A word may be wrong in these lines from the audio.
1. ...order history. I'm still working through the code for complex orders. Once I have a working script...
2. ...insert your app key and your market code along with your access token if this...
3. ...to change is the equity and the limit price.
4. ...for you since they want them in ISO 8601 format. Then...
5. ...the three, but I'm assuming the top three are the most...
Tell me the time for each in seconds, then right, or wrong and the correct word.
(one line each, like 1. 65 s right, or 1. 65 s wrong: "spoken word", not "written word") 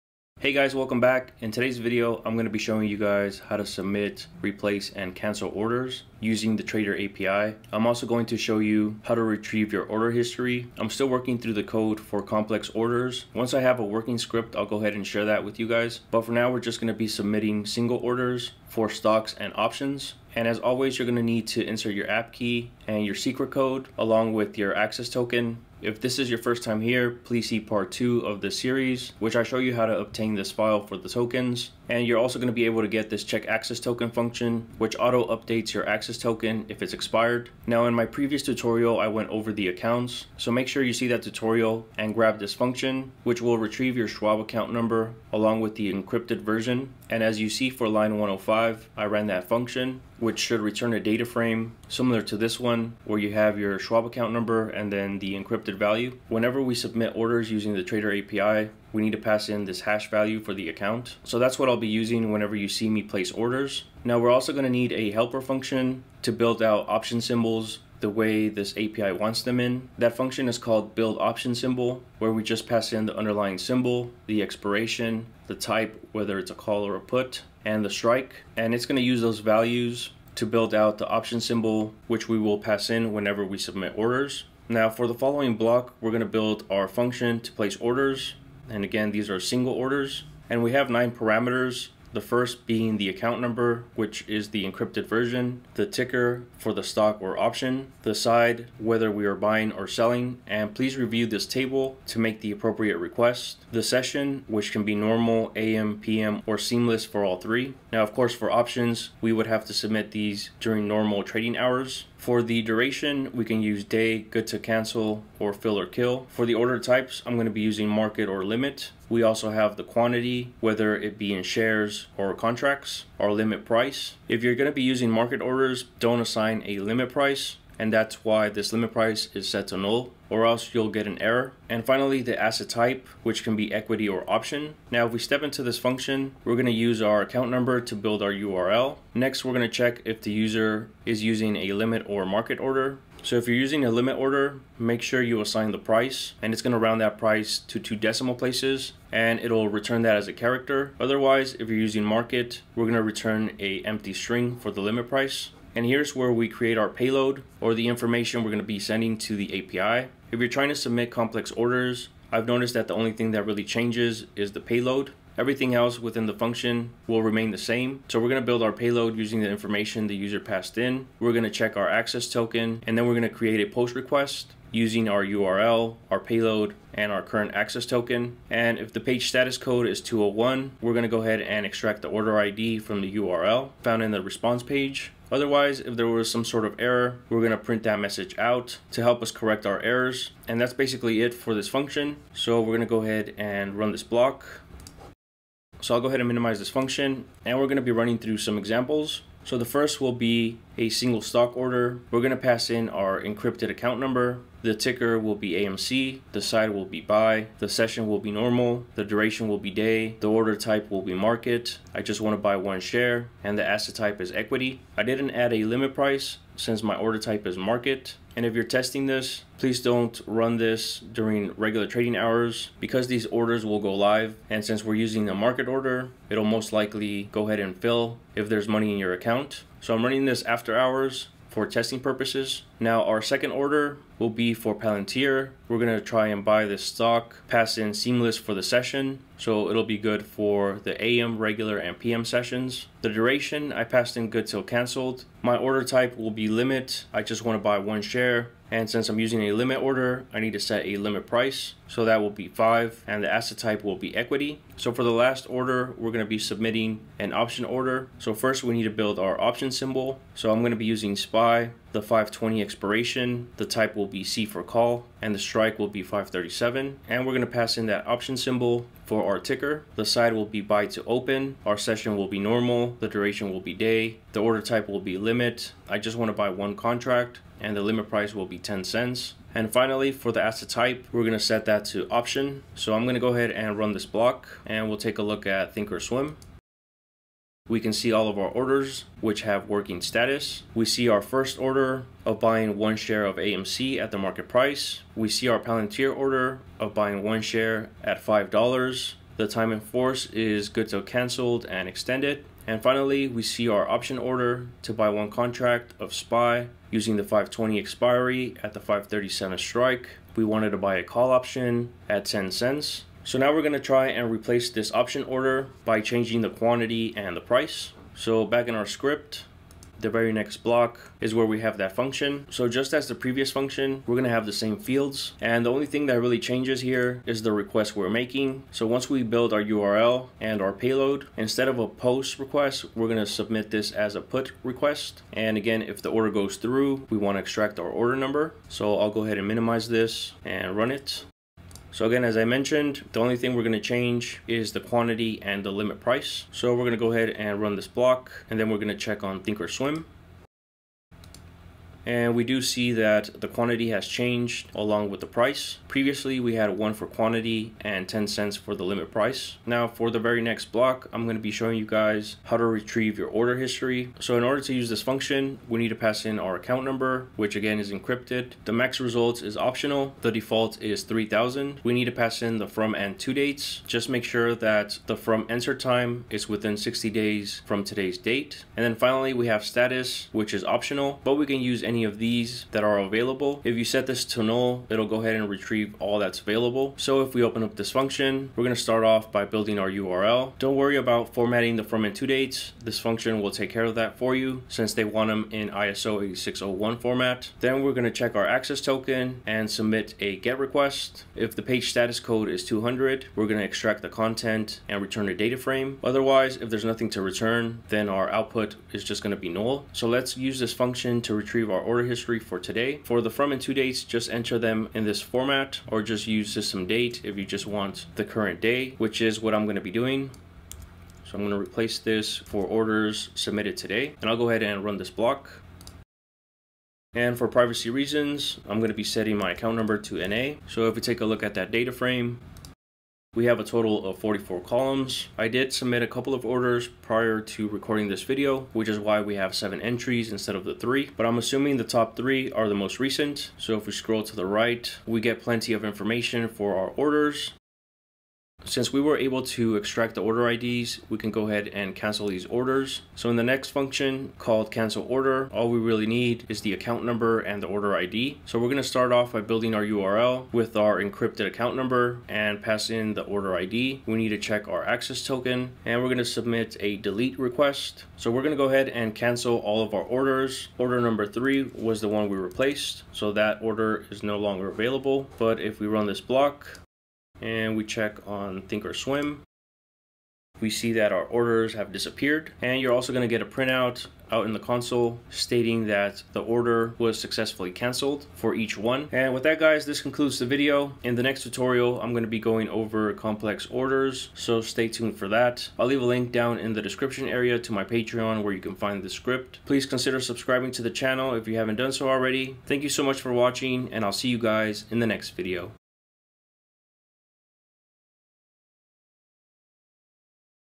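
1. 9 s right
2. 21 s wrong: "secret", not "market"
3. 343 s wrong: "quantity", not "equity"
4. 394 s right
5. 440 s right.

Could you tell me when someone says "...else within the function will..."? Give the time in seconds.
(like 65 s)
165 s.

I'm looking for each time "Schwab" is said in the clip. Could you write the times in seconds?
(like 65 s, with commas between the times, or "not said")
44 s, 53 s.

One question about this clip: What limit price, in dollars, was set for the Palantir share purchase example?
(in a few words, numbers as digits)
5.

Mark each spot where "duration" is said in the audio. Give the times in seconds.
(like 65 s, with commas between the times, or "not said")
112 s, 209 s, 243 s, 273 s.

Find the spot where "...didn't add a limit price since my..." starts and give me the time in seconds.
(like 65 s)
215 s.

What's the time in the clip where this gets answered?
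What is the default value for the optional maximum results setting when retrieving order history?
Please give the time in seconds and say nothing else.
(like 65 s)
371 s.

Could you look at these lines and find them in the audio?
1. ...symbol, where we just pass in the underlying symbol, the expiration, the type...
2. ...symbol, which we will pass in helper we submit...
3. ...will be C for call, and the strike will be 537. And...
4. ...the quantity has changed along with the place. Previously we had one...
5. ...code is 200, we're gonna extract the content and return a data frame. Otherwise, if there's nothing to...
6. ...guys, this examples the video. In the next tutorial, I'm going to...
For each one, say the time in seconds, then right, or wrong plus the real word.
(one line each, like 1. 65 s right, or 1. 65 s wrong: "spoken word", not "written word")
1. 71 s right
2. 81 s wrong: "whenever", not "helper"
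3. 263 s right
4. 353 s wrong: "price", not "place"
5. 402 s right
6. 489 s wrong: "concludes", not "examples".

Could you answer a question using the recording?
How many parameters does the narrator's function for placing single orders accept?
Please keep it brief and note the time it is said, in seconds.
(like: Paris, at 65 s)
9, at 90 s.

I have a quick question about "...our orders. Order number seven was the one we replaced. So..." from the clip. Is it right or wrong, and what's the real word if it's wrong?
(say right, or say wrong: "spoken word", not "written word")
wrong: "three", not "seven".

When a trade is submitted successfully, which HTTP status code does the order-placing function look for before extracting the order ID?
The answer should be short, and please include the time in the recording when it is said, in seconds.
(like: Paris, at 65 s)
201, at 180 s.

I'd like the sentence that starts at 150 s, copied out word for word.
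Otherwise, if you're using market, we're gonna return a empty string for the limit price.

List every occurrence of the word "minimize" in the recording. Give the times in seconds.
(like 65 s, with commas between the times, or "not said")
196 s, 339 s.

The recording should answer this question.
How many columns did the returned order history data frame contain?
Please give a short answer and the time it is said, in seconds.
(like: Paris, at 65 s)
44, at 434 s.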